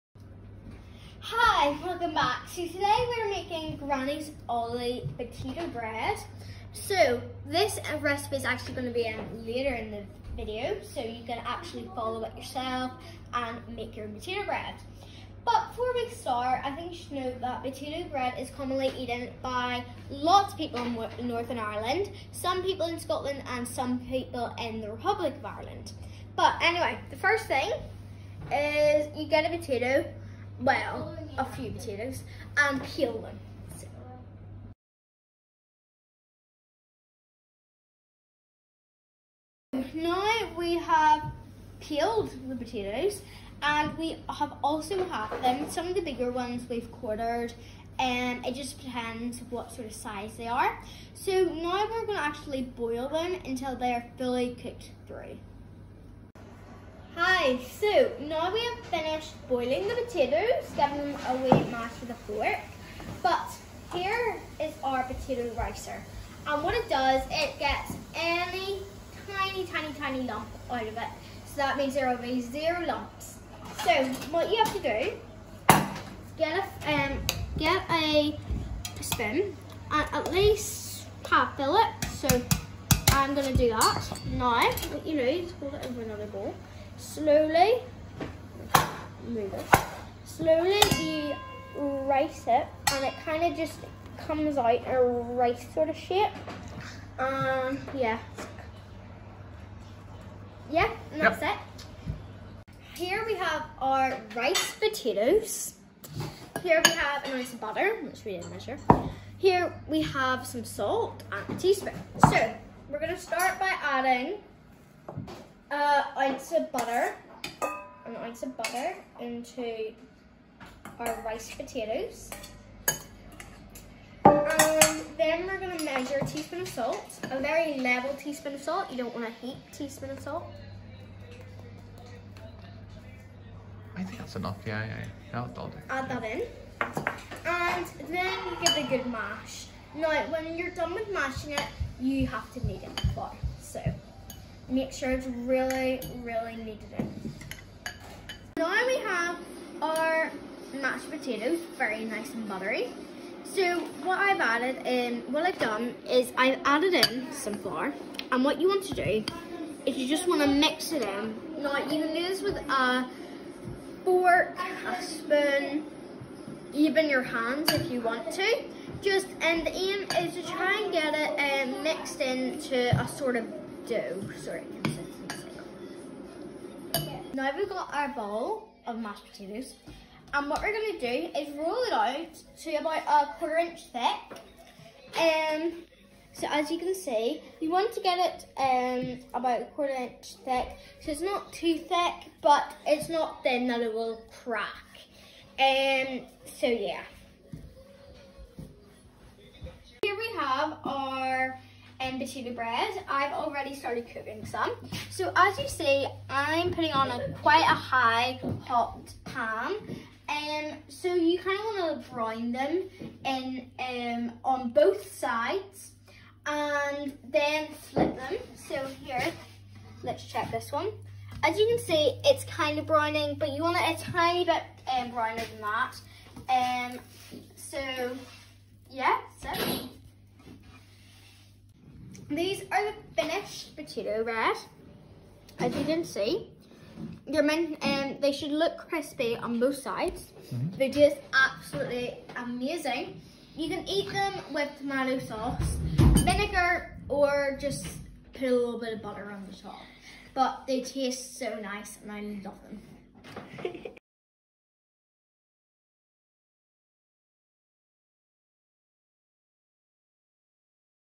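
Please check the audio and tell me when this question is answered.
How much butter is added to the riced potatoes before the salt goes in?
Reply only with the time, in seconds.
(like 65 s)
118 s.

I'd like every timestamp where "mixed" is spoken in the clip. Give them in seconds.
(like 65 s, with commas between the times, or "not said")
171 s.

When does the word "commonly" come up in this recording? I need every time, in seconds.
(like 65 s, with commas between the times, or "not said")
18 s.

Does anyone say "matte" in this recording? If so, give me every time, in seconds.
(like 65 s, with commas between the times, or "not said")
not said.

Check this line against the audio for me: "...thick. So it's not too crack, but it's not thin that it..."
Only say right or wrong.
wrong.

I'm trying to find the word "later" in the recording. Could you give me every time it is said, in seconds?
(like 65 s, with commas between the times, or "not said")
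9 s.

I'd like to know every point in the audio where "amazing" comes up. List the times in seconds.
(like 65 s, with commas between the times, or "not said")
242 s.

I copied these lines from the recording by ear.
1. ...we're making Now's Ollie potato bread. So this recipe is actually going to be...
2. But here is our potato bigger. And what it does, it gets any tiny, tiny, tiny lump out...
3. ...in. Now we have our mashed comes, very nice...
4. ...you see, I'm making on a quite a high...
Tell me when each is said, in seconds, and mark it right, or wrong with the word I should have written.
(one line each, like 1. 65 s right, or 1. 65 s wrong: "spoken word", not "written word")
1. 3 s wrong: "Granny", not "Now"
2. 63 s wrong: "ricer", not "bigger"
3. 146 s wrong: "potatoes", not "comes"
4. 205 s wrong: "putting", not "making".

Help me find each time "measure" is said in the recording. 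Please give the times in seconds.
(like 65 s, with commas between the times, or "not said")
108 s, 125 s.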